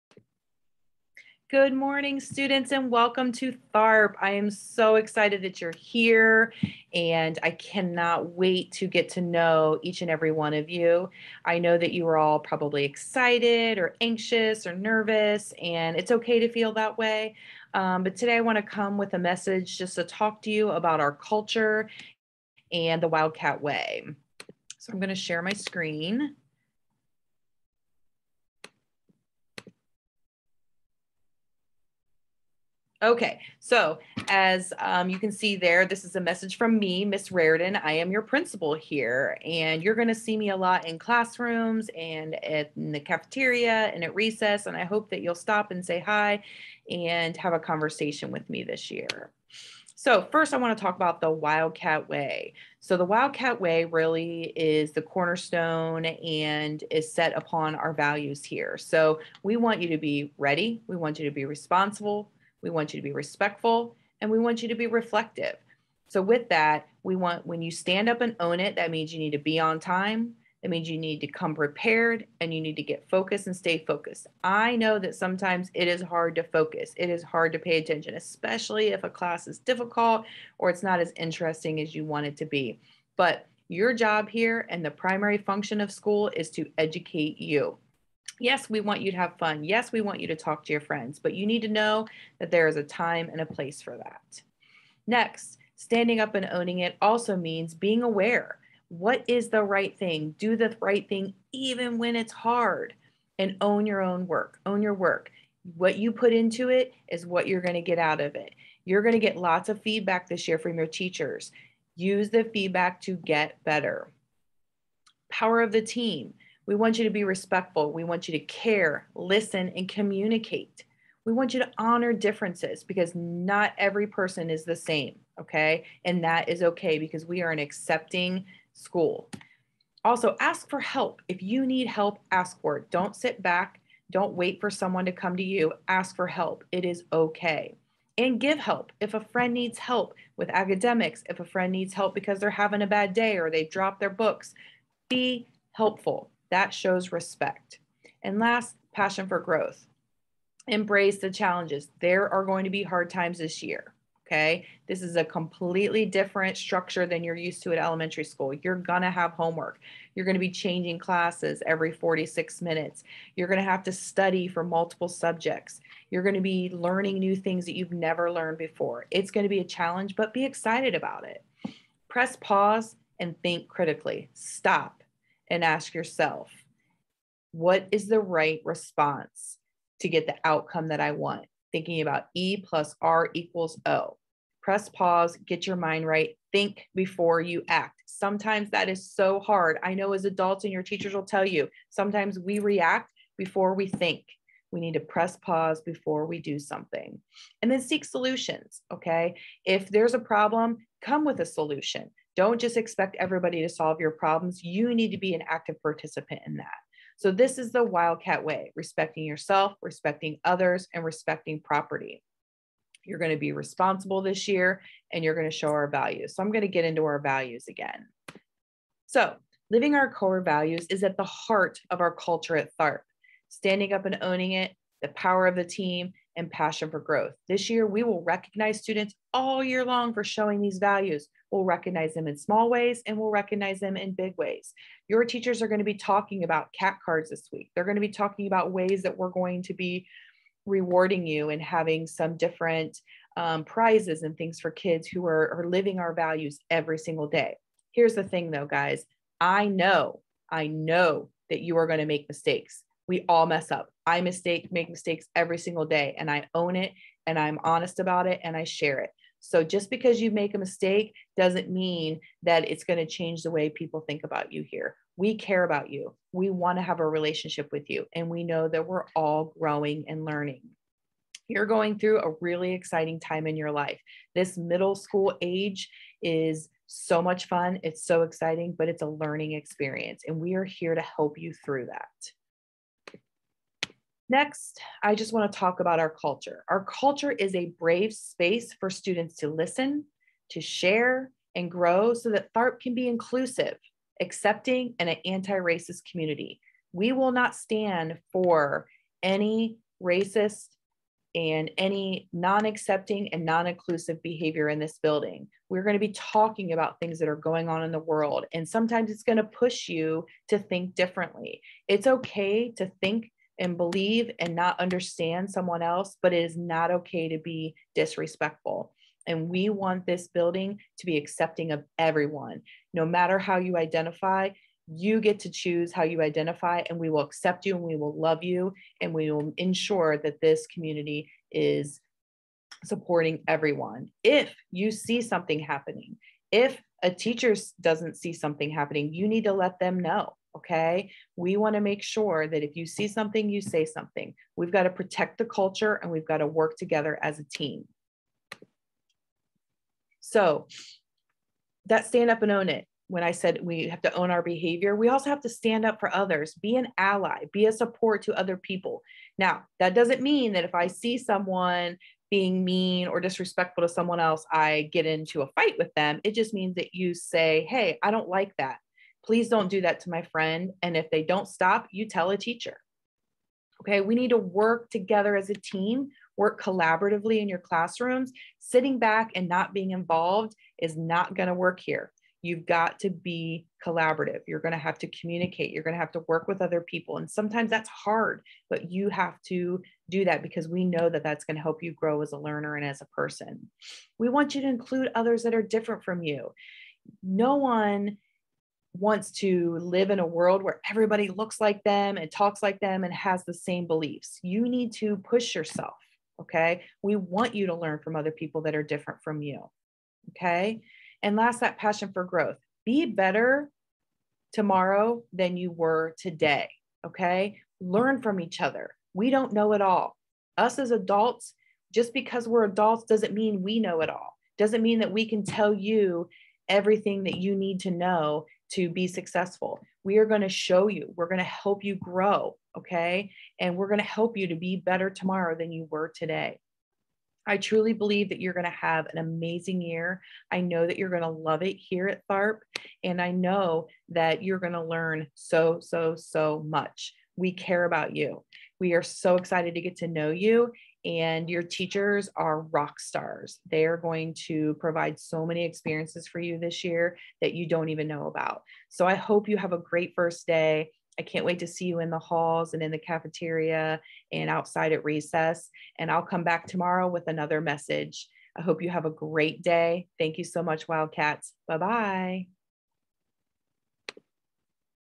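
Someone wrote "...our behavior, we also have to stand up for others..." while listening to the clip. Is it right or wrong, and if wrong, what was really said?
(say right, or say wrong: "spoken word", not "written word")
right.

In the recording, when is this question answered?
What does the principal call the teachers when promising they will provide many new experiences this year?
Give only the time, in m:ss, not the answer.
7:32.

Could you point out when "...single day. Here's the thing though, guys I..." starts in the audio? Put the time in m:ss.
4:06.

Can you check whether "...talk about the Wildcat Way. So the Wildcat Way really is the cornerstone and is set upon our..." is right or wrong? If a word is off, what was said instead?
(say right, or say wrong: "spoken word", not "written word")
right.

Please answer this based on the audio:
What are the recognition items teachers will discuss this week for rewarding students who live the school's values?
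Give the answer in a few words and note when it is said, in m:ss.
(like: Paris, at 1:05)
cat cards, at 3:56.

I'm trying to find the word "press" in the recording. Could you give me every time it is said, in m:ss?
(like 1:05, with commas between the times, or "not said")
2:52, 3:04, 3:15.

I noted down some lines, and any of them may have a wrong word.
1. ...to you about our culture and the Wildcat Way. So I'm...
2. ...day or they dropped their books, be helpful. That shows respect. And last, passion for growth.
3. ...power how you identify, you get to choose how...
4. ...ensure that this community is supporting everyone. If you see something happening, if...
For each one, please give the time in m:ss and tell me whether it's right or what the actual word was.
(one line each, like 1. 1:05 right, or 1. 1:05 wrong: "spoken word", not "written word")
1. 0:20 right
2. 2:23 right
3. 5:23 wrong: "matter", not "power"
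4. 5:29 right.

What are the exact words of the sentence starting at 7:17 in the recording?
I truly believe that you're going to have an amazing year.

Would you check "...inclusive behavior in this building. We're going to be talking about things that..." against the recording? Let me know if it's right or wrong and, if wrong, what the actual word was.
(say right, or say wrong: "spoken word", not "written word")
right.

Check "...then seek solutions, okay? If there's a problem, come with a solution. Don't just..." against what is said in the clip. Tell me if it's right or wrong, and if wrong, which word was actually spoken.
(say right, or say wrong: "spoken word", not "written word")
right.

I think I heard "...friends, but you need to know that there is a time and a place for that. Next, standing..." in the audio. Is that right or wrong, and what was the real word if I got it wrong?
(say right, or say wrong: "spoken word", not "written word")
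right.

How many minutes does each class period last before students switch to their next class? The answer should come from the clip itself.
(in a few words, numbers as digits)
46.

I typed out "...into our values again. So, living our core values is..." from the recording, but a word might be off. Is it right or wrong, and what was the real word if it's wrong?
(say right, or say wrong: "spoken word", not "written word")
right.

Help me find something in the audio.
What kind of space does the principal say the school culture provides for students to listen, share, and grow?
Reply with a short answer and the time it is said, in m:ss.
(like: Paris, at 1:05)
brave space, at 4:47.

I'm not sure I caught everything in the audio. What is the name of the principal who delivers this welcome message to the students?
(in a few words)
Miss Rardon.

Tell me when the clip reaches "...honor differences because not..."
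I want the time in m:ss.
2:01.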